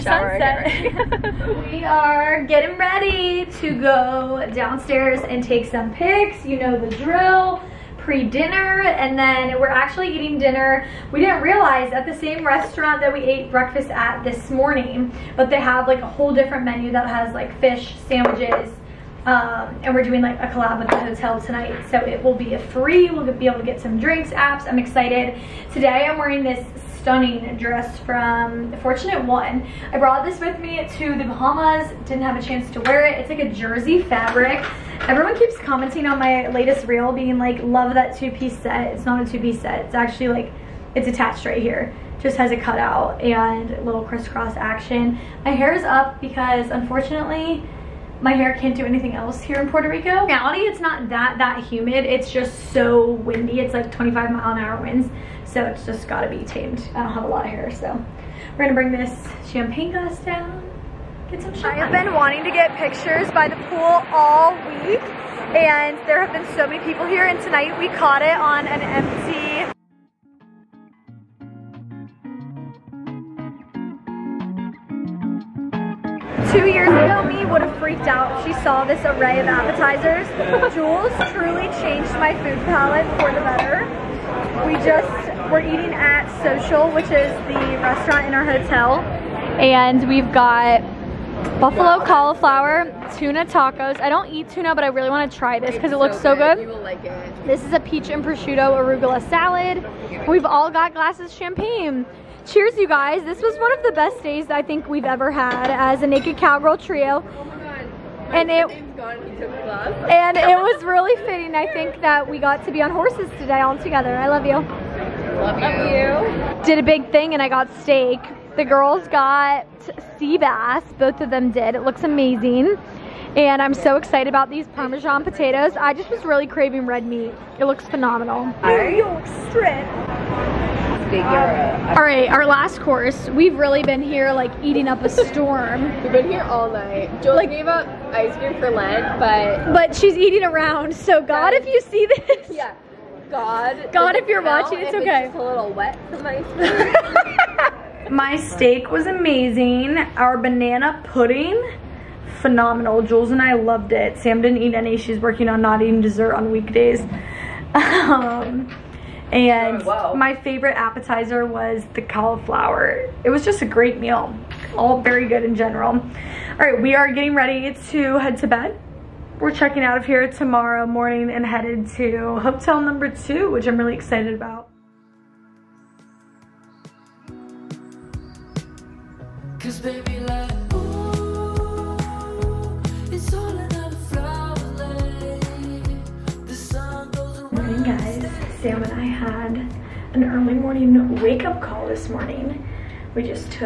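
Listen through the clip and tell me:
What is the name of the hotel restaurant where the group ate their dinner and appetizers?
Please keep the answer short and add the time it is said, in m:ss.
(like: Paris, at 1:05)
Social, at 1:26.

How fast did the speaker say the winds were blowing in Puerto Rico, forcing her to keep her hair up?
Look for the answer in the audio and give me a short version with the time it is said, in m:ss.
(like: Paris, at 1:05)
25 mph, at 0:53.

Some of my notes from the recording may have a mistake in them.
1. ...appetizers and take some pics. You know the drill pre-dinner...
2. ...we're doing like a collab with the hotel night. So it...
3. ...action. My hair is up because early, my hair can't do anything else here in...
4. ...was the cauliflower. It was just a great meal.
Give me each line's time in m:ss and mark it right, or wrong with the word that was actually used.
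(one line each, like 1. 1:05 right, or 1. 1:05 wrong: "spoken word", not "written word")
1. 0:04 wrong: "downstairs", not "appetizers"
2. 0:19 wrong: "tonight", not "night"
3. 0:44 wrong: "unfortunately", not "early"
4. 2:41 right.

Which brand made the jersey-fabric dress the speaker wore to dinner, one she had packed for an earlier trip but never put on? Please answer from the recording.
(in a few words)
Fortunate One.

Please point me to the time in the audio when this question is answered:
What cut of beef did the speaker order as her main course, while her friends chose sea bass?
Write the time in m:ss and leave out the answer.
2:08.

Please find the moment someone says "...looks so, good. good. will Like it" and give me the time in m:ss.
1:35.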